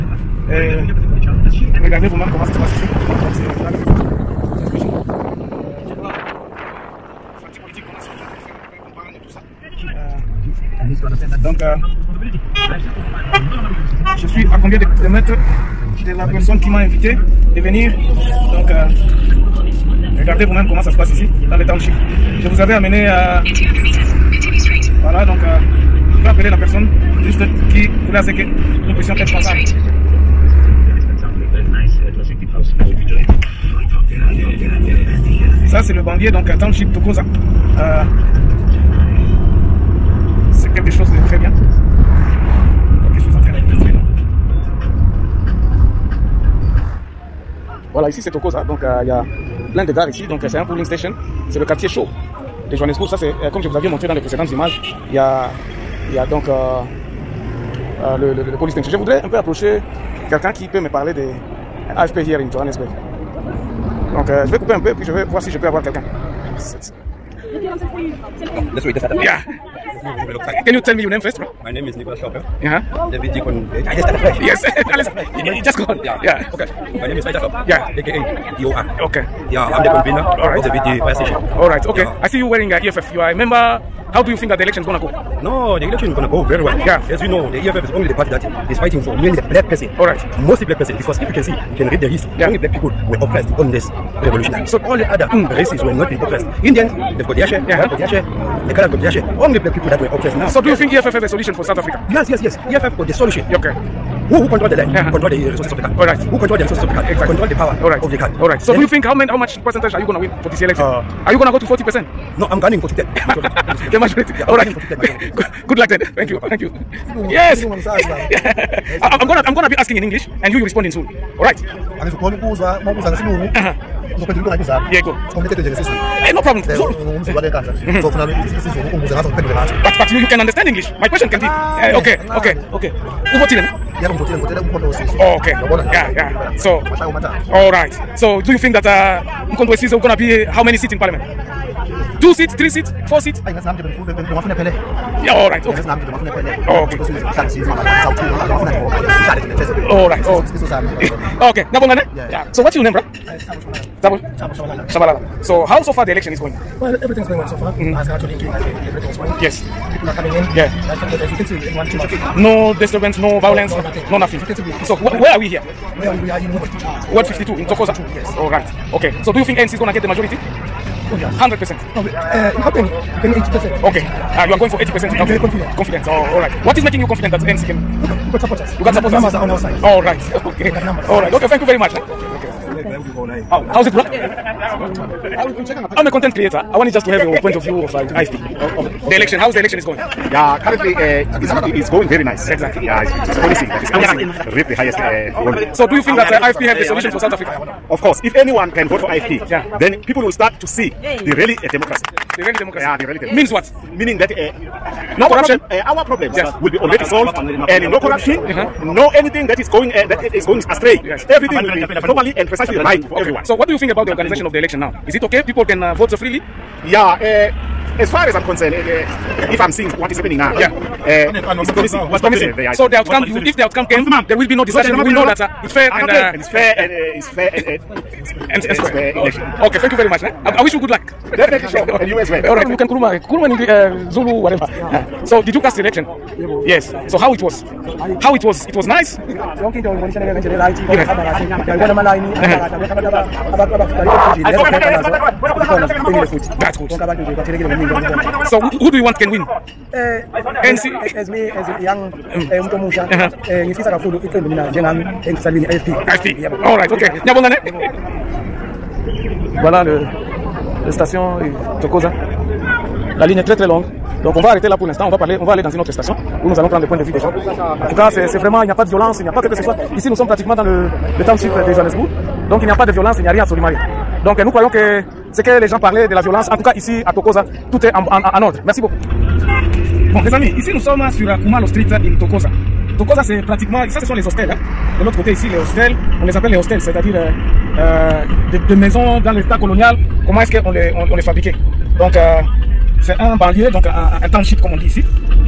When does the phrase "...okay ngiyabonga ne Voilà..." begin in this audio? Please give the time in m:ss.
4:16.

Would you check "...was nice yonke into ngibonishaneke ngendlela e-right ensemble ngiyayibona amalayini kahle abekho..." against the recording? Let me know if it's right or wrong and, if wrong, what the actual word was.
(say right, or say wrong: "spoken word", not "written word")
wrong: "kahle", not "ensemble".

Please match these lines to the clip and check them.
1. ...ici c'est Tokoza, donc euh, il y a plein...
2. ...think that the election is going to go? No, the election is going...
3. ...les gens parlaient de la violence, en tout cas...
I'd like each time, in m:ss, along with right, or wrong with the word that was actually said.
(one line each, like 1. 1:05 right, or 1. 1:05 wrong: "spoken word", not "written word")
1. 0:48 right
2. 1:24 right
3. 4:35 right.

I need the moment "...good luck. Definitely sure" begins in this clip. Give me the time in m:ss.
3:50.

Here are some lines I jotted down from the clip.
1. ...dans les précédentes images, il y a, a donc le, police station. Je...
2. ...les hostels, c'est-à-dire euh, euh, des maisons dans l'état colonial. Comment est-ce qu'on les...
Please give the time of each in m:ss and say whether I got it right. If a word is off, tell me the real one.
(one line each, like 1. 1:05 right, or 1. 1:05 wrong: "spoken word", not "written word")
1. 0:54 right
2. 4:46 right.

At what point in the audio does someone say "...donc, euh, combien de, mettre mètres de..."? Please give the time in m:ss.
0:11.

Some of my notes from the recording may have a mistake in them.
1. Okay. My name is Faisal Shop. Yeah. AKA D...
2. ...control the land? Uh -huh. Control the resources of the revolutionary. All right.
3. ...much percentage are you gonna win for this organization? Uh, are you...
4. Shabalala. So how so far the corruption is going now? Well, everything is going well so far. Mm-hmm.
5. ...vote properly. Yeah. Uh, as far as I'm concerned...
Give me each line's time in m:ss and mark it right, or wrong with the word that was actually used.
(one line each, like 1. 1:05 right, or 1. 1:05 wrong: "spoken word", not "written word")
1. 1:16 right
2. 1:44 wrong: "country", not "revolutionary"
3. 1:49 wrong: "election", not "organization"
4. 2:34 wrong: "election", not "corruption"
5. 3:35 wrong: "freely", not "properly".